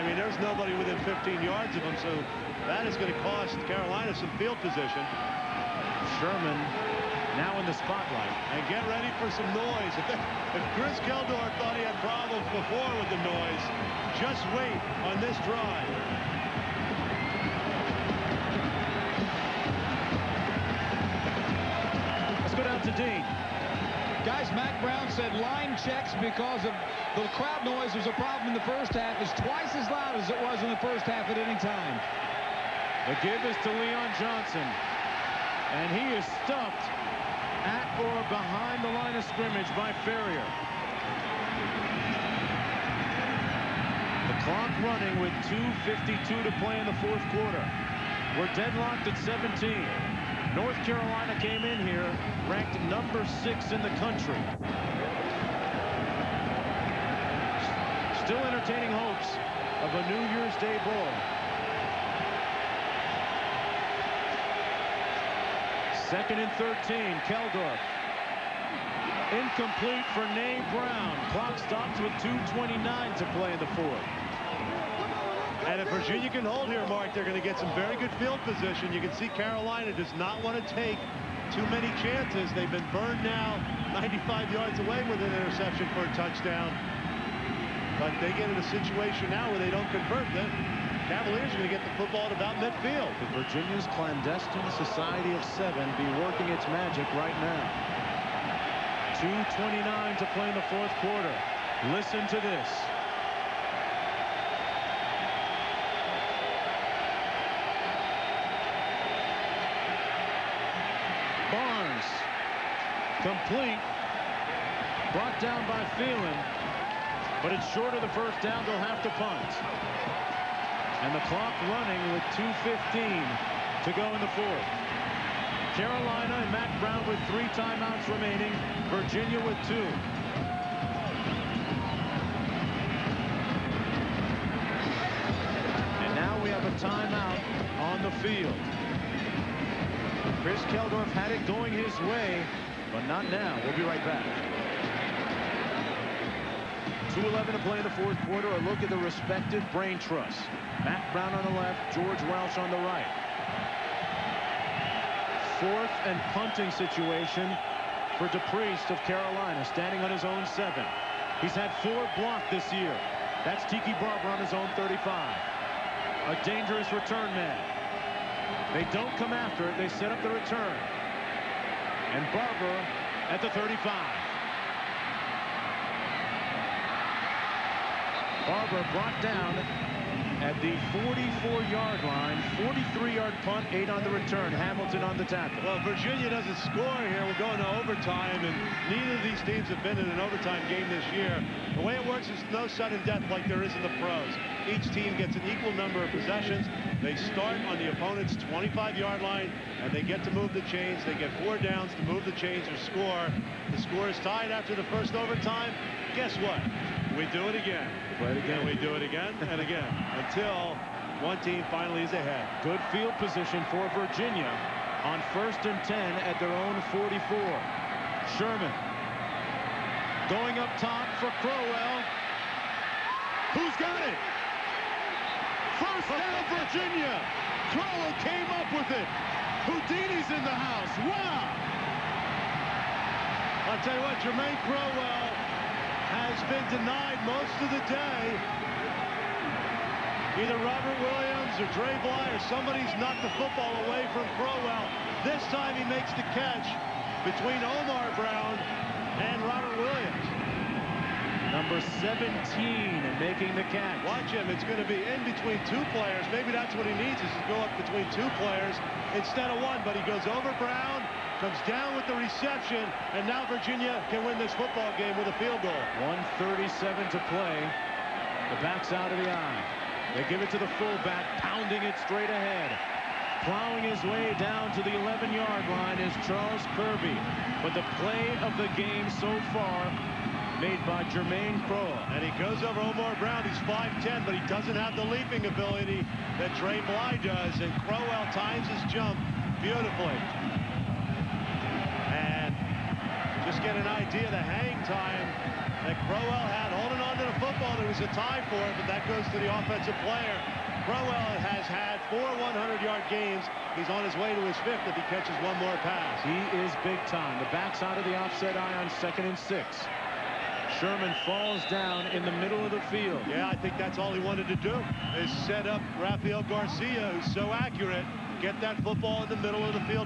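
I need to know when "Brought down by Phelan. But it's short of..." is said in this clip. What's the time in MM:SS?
01:55.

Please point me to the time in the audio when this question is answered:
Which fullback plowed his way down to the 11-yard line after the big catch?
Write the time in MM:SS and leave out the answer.
04:36.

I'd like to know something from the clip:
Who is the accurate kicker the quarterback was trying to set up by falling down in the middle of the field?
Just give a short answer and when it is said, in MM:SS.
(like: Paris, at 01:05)
Rafael Garcia, at 05:16.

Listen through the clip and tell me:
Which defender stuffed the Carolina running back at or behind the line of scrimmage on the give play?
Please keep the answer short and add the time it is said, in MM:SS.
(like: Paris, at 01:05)
Farrior, at 00:40.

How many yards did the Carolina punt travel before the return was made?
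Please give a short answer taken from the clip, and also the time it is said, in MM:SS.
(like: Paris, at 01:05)
43, at 03:02.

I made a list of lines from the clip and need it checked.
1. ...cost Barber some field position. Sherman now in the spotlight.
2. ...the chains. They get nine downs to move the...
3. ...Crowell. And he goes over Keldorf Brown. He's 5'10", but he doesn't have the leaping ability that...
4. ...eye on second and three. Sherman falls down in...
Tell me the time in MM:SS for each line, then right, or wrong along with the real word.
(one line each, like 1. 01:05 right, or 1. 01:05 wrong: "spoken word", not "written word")
1. 00:03 wrong: "Carolina", not "Barber"
2. 03:20 wrong: "four", not "nine"
3. 04:41 wrong: "Omar", not "Keldorf"
4. 05:08 wrong: "six", not "three".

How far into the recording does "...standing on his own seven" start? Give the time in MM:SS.
02:39.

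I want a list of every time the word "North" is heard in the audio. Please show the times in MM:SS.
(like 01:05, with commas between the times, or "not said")
00:50.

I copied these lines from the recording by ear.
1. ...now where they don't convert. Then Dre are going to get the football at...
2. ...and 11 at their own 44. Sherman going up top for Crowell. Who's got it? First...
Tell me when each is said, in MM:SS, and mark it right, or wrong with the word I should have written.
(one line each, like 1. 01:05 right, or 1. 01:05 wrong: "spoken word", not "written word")
1. 01:29 wrong: "Cavaliers", not "Dre"
2. 03:35 wrong: "10", not "11".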